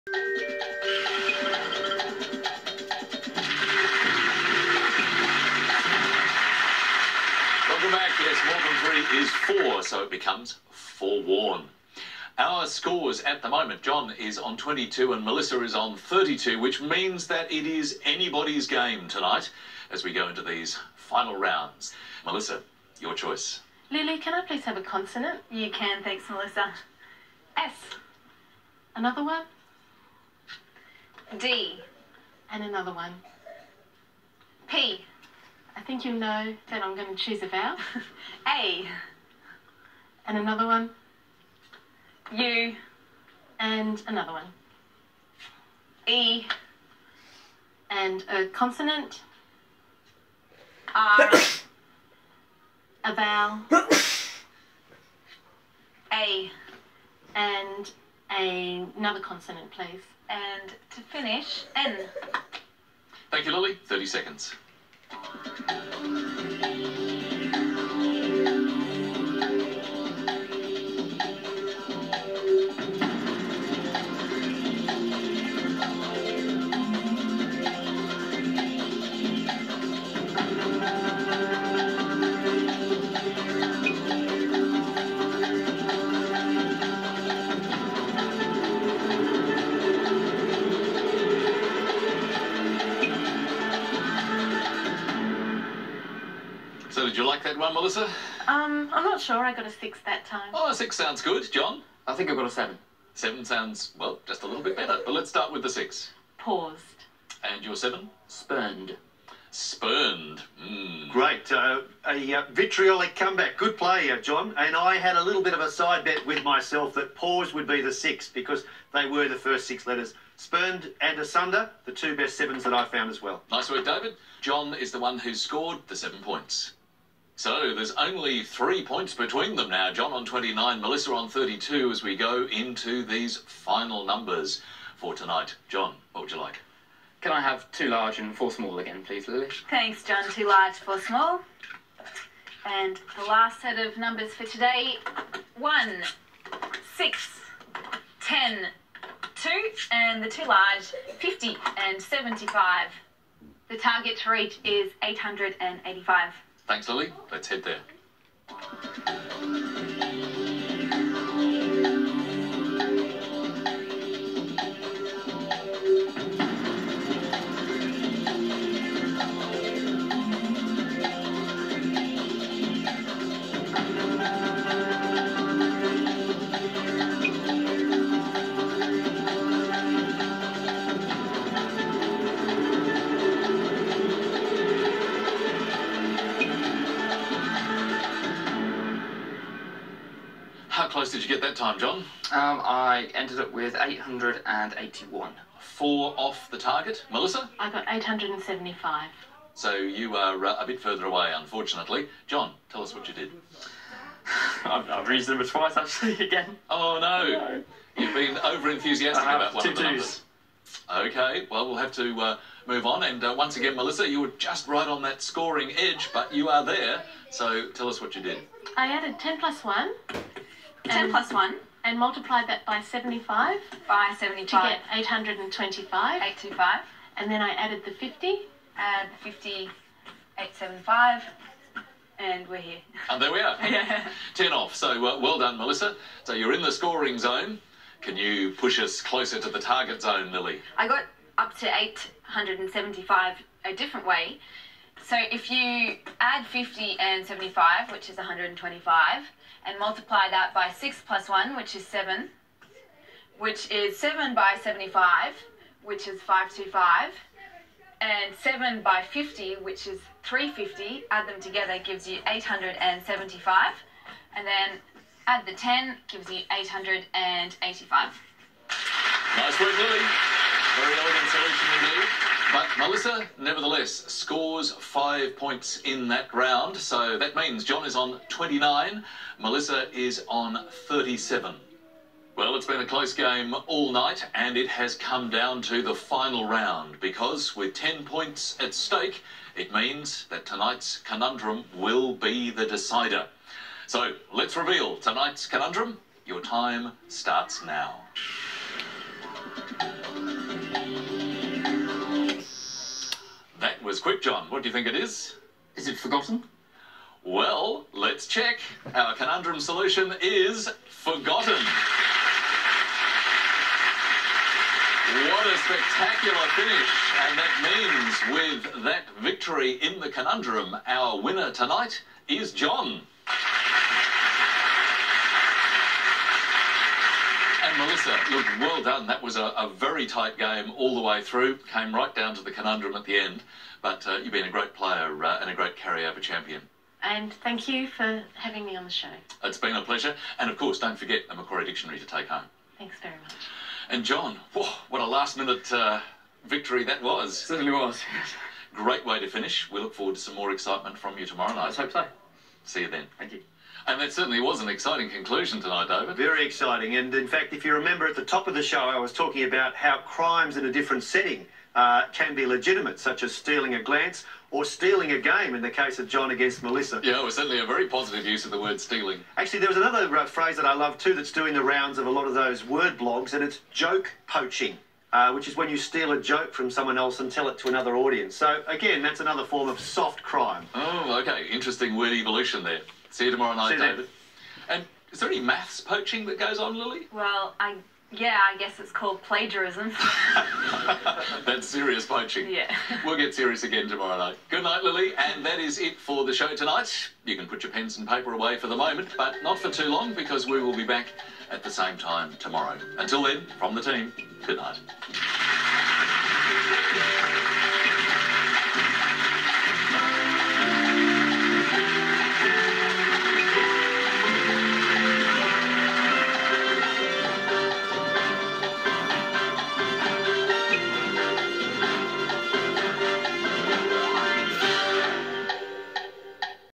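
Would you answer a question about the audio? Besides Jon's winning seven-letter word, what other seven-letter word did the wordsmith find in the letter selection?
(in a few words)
Asunder.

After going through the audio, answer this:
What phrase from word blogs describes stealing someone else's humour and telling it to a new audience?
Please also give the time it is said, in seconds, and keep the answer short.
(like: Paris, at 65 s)
joke poaching, at 373 s.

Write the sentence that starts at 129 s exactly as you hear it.
Jon on 29, Melissa on 32 as we go into these final numbers for tonight.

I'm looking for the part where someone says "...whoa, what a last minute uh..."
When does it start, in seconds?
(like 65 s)
344 s.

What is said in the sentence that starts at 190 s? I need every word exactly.
close did you get that time, Jon?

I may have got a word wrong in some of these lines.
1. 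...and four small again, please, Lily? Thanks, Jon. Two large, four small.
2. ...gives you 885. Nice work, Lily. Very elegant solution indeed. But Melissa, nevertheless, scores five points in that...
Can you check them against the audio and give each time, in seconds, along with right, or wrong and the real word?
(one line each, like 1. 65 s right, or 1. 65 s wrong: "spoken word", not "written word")
1. 138 s right
2. 266 s right.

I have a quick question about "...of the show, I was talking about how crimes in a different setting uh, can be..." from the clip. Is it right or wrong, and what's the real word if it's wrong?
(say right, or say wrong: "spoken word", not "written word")
right.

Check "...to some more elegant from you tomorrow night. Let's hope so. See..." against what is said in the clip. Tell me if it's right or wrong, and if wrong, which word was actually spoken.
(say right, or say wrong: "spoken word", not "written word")
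wrong: "excitement", not "elegant".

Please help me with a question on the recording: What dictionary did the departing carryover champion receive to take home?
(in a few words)
Macquarie Dictionary.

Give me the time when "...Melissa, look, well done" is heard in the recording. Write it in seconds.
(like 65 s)
327 s.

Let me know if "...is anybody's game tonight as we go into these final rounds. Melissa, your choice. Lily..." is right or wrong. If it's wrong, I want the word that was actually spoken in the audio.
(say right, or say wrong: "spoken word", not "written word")
right.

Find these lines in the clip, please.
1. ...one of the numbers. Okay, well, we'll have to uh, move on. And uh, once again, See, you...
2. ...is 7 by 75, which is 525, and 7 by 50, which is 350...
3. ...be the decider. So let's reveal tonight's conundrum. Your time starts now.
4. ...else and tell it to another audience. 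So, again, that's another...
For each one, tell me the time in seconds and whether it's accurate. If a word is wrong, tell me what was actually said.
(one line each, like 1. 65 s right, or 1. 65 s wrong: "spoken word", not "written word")
1. 209 s wrong: "Melissa", not "See"
2. 253 s right
3. 292 s right
4. 376 s right.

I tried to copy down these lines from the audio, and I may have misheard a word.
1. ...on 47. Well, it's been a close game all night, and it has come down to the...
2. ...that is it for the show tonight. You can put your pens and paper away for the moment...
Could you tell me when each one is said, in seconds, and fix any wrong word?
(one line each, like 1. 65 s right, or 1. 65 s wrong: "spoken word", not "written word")
1. 280 s wrong: "37", not "47"
2. 395 s right.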